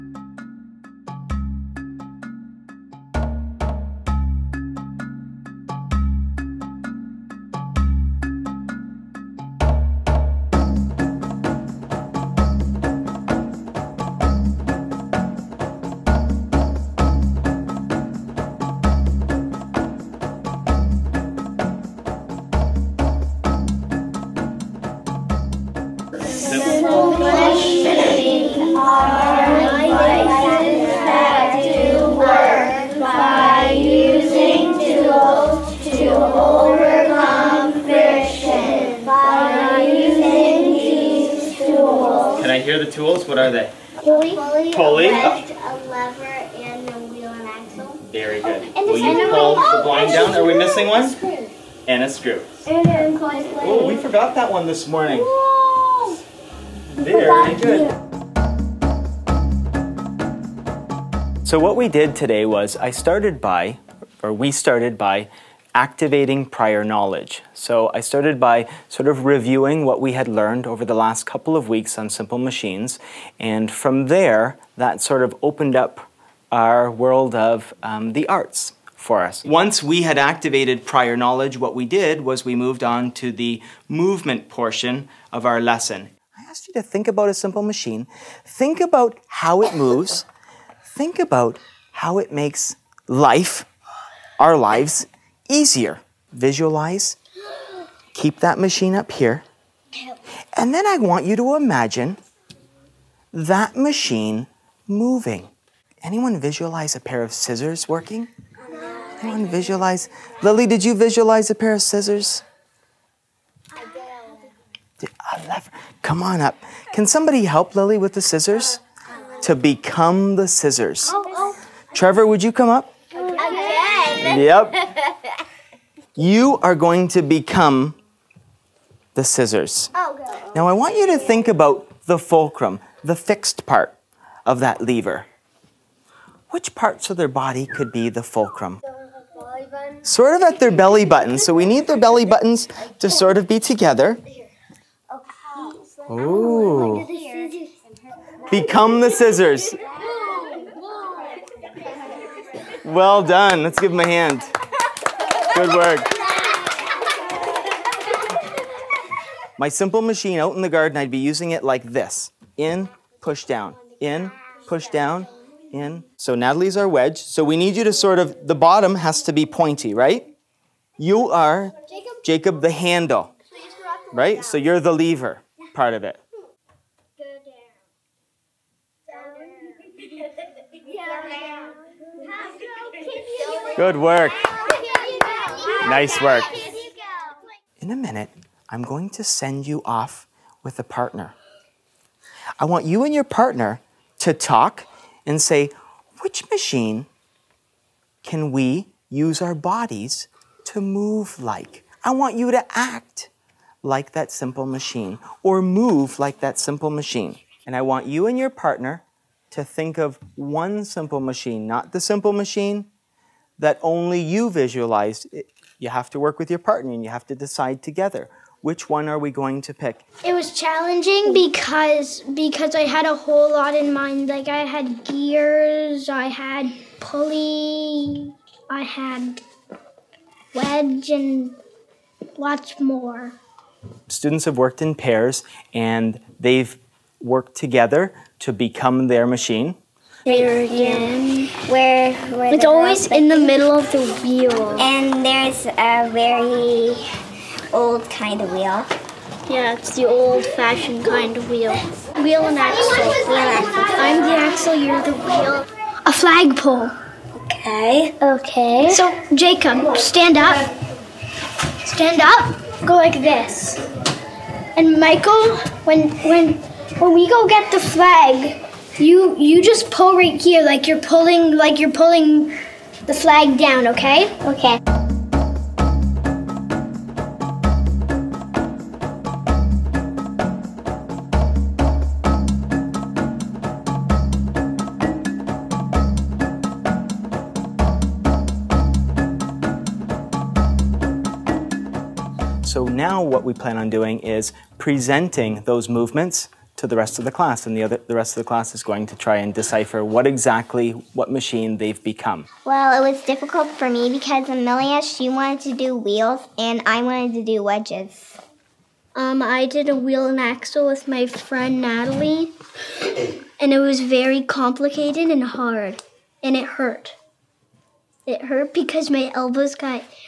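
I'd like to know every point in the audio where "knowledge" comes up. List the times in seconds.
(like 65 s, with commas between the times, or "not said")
66 s, 81 s.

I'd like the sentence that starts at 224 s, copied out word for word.
Like I had gears, I had pulley, I had wedge and lots more.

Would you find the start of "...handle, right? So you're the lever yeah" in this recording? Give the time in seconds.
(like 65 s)
172 s.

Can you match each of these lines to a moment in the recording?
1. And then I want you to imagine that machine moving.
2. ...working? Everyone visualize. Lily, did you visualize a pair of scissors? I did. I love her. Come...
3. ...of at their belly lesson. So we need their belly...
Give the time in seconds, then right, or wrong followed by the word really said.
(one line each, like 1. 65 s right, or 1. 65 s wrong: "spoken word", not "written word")
1. 100 s right
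2. 107 s right
3. 140 s wrong: "button", not "lesson".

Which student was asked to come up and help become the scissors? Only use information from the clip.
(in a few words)
Trevor.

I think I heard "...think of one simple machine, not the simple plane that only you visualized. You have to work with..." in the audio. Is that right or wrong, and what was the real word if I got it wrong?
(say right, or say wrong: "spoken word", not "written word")
wrong: "machine", not "plane".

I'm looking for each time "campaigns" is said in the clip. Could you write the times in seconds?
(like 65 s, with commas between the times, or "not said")
not said.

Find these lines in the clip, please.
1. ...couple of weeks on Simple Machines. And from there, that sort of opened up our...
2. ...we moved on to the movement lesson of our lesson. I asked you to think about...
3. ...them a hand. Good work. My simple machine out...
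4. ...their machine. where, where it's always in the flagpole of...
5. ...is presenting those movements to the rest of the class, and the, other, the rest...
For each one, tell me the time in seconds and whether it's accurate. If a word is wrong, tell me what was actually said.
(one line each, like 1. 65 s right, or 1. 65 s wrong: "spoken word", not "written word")
1. 71 s right
2. 82 s wrong: "portion", not "lesson"
3. 153 s right
4. 239 s wrong: "middle", not "flagpole"
5. 294 s right.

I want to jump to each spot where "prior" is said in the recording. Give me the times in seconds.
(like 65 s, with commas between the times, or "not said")
66 s, 80 s.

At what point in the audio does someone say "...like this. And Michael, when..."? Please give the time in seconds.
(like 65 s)
262 s.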